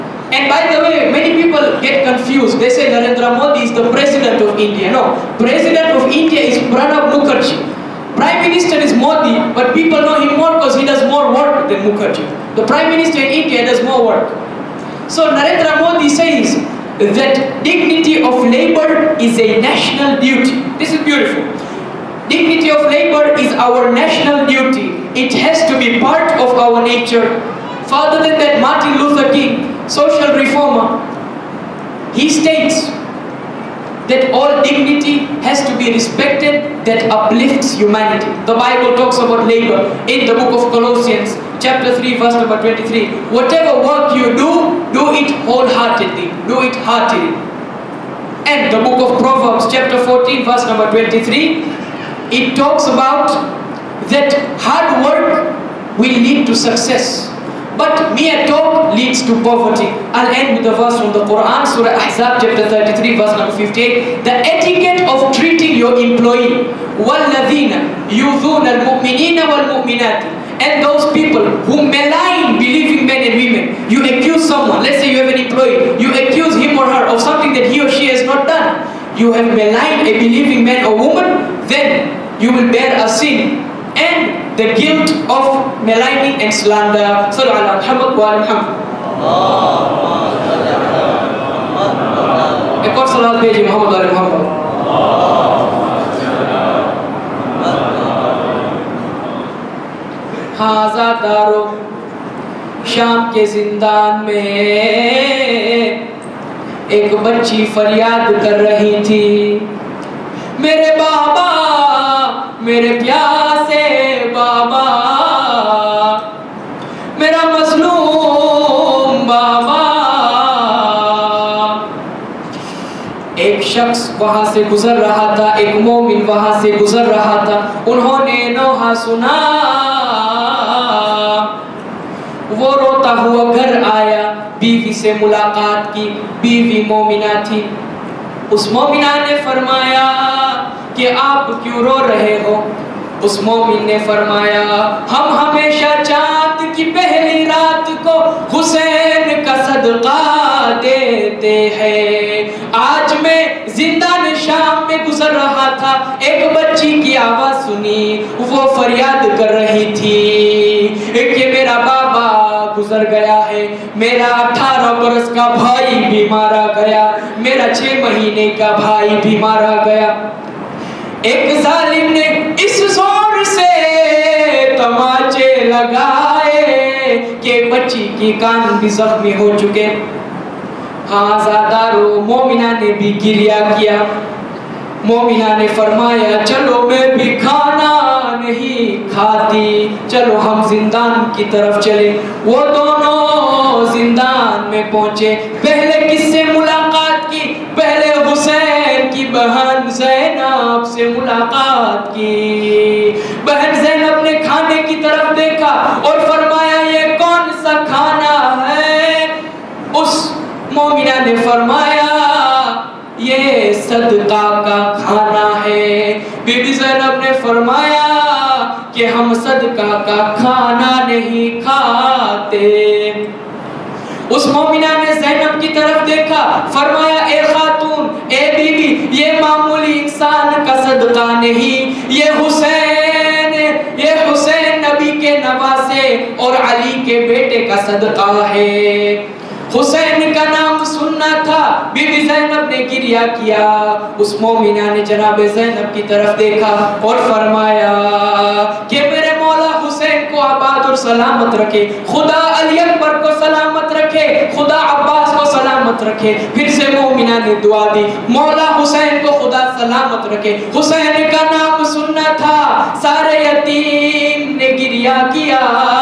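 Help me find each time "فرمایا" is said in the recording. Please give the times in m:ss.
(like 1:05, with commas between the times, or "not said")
2:19, 2:24, 3:05, 3:26, 3:31, 3:37, 3:46, 4:07.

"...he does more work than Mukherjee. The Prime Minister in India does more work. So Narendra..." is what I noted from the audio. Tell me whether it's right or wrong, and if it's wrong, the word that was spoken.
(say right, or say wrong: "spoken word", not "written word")
right.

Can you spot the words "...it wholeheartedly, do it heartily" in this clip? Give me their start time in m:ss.
0:45.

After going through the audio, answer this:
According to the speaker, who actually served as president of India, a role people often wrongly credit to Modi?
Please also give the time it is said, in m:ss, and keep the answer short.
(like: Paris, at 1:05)
Pranab Mukherjee, at 0:06.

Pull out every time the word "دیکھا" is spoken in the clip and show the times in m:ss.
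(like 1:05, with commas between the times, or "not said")
3:25, 3:46, 4:06.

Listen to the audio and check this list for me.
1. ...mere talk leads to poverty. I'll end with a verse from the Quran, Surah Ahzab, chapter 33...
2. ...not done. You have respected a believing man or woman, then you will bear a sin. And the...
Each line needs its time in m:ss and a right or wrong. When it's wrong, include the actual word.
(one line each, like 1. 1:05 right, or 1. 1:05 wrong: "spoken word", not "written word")
1. 0:58 right
2. 1:18 wrong: "maligned", not "respected".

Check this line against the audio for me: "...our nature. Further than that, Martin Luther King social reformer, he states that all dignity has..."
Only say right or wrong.
right.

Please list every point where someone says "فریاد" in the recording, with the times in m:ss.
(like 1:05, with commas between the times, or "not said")
1:47, 2:38.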